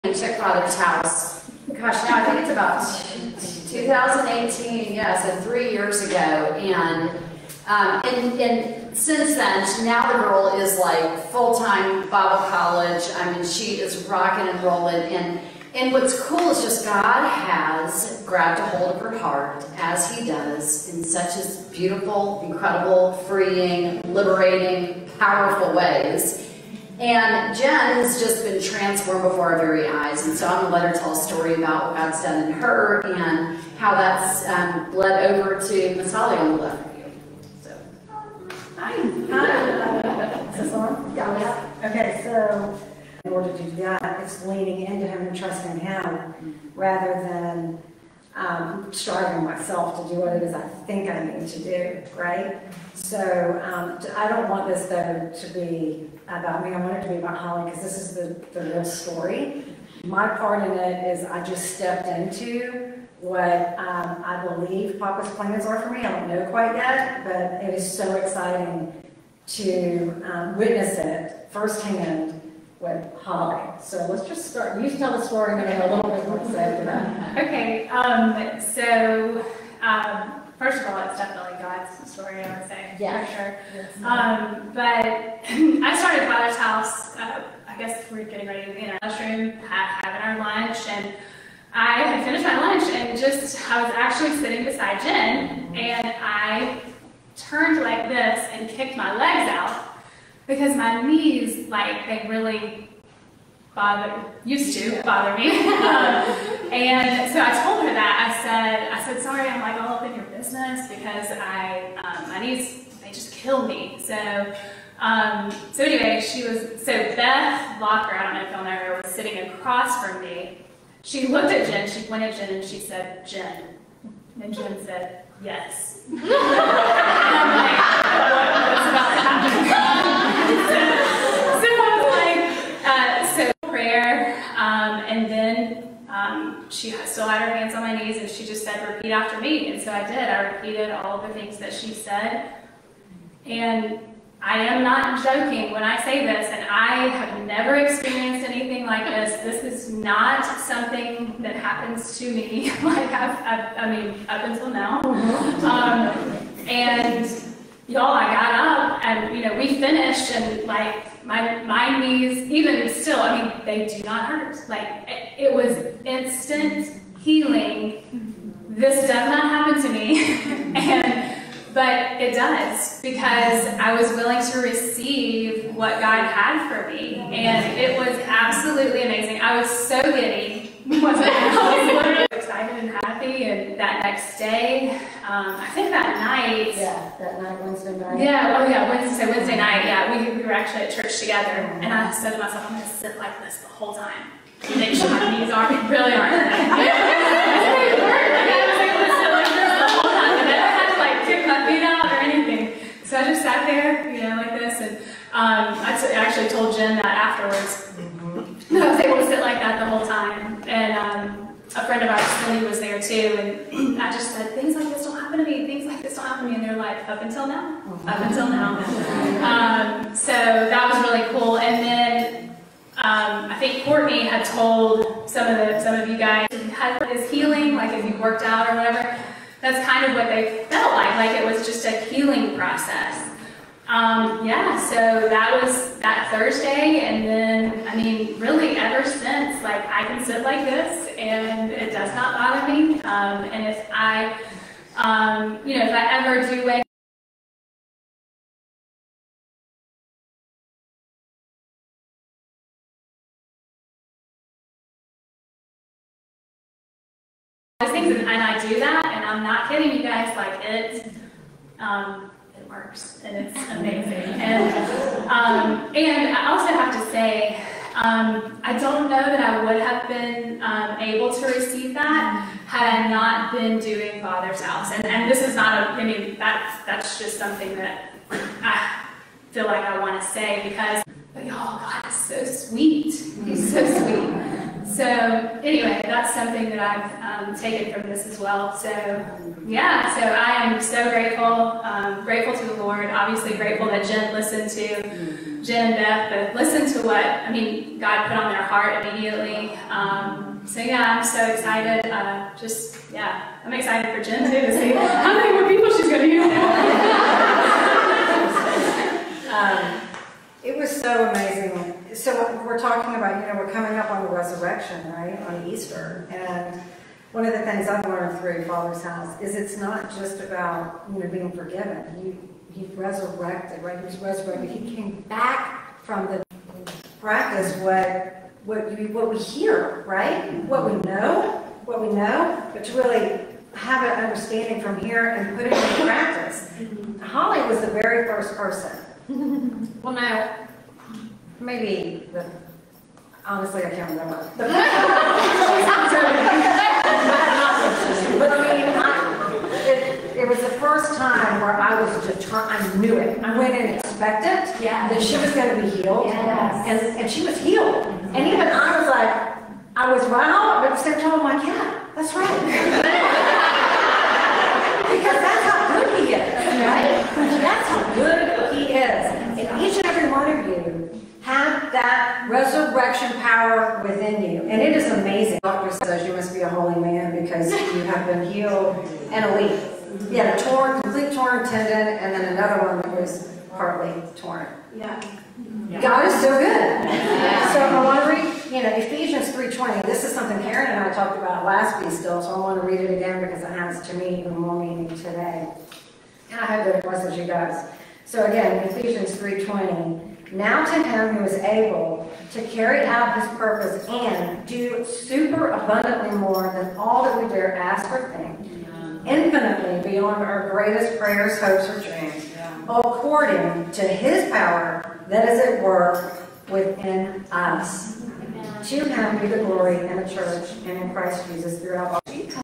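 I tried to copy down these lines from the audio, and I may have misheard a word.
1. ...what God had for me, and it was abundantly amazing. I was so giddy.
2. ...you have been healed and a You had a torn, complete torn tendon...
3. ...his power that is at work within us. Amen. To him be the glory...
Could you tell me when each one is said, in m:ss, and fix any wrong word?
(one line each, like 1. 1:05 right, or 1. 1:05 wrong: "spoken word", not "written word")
1. 2:55 wrong: "absolutely", not "abundantly"
2. 6:17 right
3. 6:54 right.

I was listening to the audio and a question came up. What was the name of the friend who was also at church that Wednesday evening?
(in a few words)
Lily.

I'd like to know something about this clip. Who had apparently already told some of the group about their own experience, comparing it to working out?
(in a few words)
Courtney.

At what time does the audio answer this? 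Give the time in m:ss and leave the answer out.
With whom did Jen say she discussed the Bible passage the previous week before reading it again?
6:30.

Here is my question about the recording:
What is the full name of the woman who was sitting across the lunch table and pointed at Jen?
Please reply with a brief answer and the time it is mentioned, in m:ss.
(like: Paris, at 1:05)
Beth Locker, at 1:57.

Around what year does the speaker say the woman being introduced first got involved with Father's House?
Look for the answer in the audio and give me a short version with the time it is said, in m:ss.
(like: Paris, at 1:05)
2018, at 0:03.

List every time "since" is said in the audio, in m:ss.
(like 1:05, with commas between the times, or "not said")
0:08, 3:59.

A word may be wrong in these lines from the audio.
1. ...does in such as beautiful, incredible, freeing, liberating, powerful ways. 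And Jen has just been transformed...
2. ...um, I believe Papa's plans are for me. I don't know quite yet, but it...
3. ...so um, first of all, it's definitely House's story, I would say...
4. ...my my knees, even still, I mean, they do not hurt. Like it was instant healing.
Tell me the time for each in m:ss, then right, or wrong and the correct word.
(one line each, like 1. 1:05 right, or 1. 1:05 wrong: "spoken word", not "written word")
1. 0:20 right
2. 1:03 right
3. 1:18 wrong: "God", not "House"
4. 2:41 right.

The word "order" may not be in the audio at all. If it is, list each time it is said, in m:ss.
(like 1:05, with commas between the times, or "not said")
0:43.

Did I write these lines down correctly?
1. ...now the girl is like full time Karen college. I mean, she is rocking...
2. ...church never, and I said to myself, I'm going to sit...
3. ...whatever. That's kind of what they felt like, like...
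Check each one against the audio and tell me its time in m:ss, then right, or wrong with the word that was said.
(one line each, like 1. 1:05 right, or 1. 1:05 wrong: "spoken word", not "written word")
1. 0:09 wrong: "Bible", not "Karen"
2. 3:10 wrong: "together", not "never"
3. 3:48 right.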